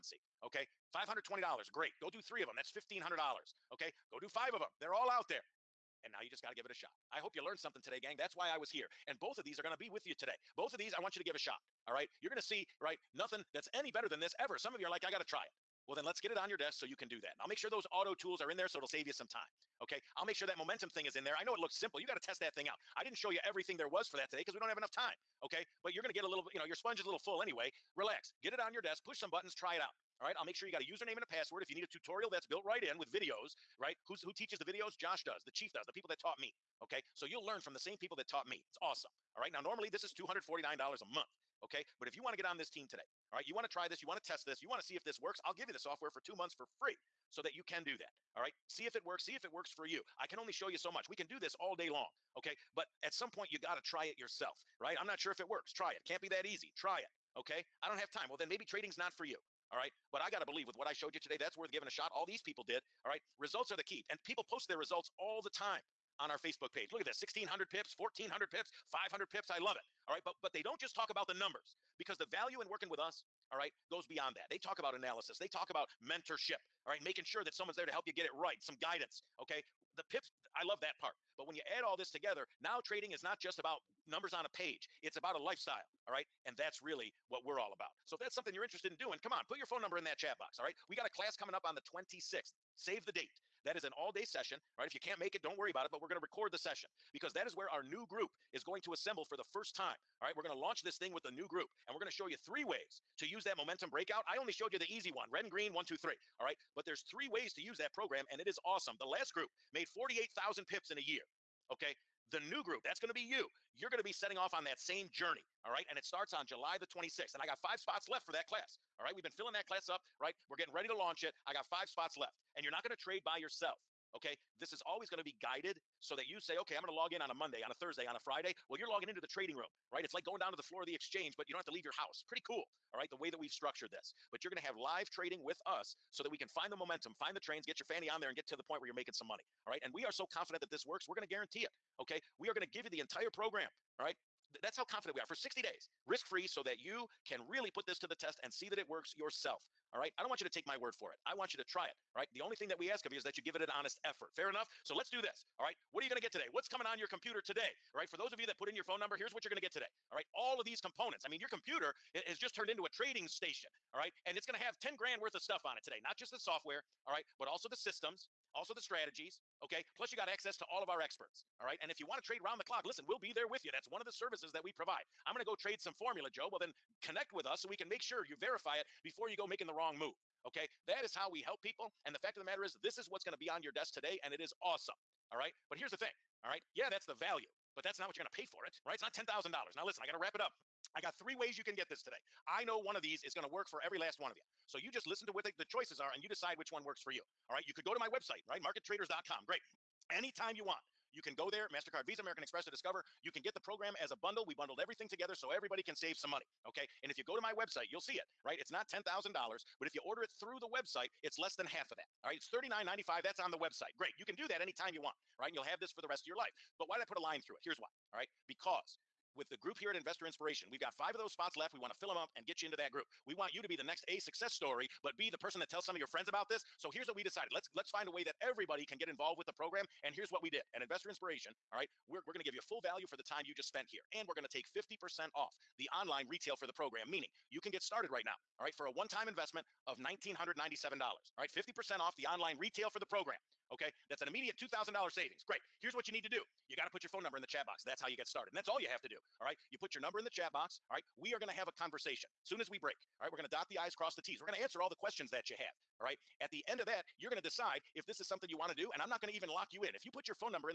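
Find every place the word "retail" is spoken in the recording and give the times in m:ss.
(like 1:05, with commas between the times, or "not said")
3:56, 4:02.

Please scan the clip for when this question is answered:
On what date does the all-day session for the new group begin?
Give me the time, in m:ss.
1:56.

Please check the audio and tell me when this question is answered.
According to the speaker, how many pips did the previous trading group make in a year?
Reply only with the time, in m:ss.
1:49.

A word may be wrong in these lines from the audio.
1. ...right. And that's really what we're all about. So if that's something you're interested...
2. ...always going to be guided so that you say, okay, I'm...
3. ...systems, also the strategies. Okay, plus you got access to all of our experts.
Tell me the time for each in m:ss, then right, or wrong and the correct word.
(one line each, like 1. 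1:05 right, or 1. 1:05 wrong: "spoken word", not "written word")
1. 1:26 right
2. 2:04 right
3. 2:47 right.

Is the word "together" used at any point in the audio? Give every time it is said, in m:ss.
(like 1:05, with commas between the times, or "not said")
1:22, 3:25.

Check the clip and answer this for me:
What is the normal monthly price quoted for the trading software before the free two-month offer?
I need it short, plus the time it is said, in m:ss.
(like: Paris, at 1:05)
$249, at 0:40.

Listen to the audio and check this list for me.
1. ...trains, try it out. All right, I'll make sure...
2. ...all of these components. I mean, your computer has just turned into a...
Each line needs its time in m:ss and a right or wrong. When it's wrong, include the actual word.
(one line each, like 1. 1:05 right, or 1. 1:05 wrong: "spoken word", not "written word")
1. 0:29 wrong: "buttons", not "trains"
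2. 2:40 right.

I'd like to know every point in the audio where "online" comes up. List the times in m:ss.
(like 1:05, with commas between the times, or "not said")
3:55, 4:02.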